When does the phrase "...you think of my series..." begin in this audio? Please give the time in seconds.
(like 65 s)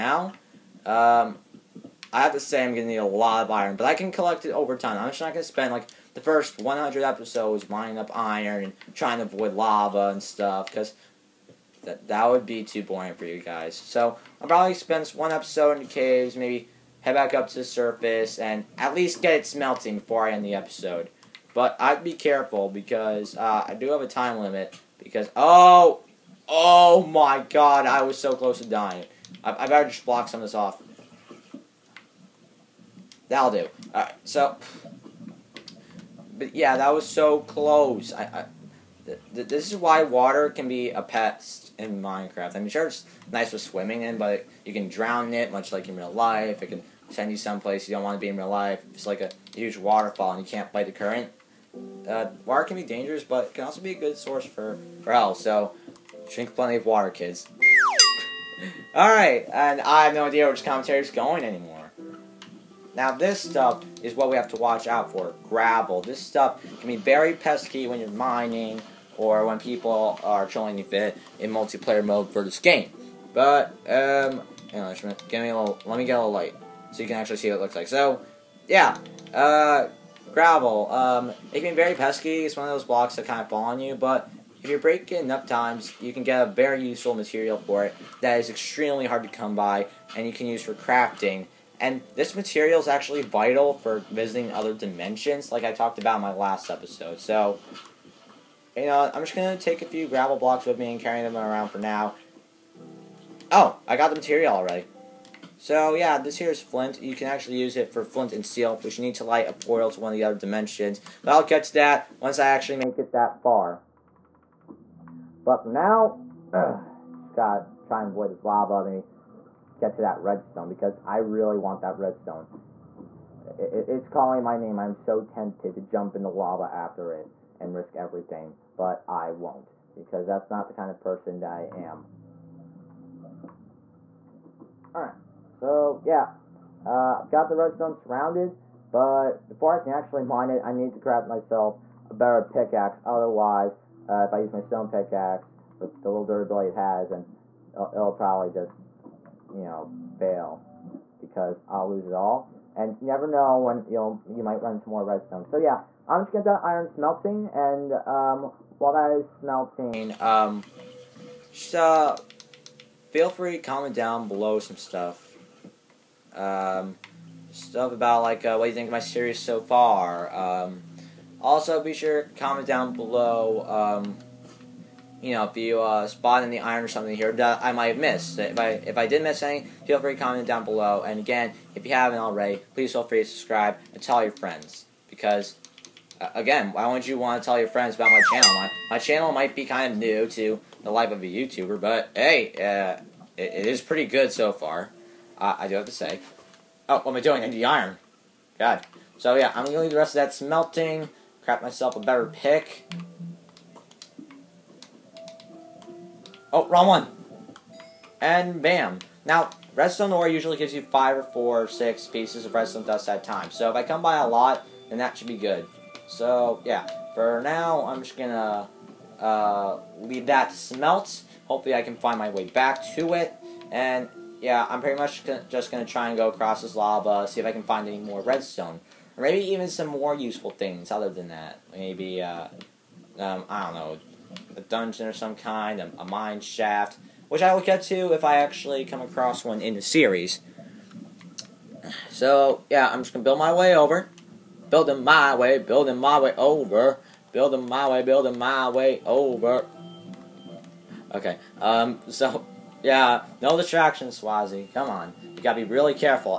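168 s.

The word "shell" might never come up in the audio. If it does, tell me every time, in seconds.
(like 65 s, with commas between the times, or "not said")
not said.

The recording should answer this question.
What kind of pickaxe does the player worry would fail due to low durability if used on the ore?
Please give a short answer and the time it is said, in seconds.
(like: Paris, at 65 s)
stone pickaxe, at 144 s.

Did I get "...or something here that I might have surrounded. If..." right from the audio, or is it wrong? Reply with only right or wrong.
wrong.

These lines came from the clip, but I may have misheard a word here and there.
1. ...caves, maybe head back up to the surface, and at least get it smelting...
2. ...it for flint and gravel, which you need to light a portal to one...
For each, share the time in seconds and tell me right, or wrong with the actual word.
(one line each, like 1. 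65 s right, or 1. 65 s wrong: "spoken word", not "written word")
1. 15 s right
2. 107 s wrong: "steel", not "gravel".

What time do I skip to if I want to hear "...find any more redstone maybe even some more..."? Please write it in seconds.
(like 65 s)
227 s.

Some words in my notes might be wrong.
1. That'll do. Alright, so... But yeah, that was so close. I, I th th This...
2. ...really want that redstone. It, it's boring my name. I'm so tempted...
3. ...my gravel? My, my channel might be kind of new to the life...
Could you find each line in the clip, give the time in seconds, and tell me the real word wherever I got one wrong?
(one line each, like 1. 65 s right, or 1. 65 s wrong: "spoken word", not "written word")
1. 33 s right
2. 121 s wrong: "calling", not "boring"
3. 188 s wrong: "channel", not "gravel".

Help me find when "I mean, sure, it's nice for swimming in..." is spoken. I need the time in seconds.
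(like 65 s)
42 s.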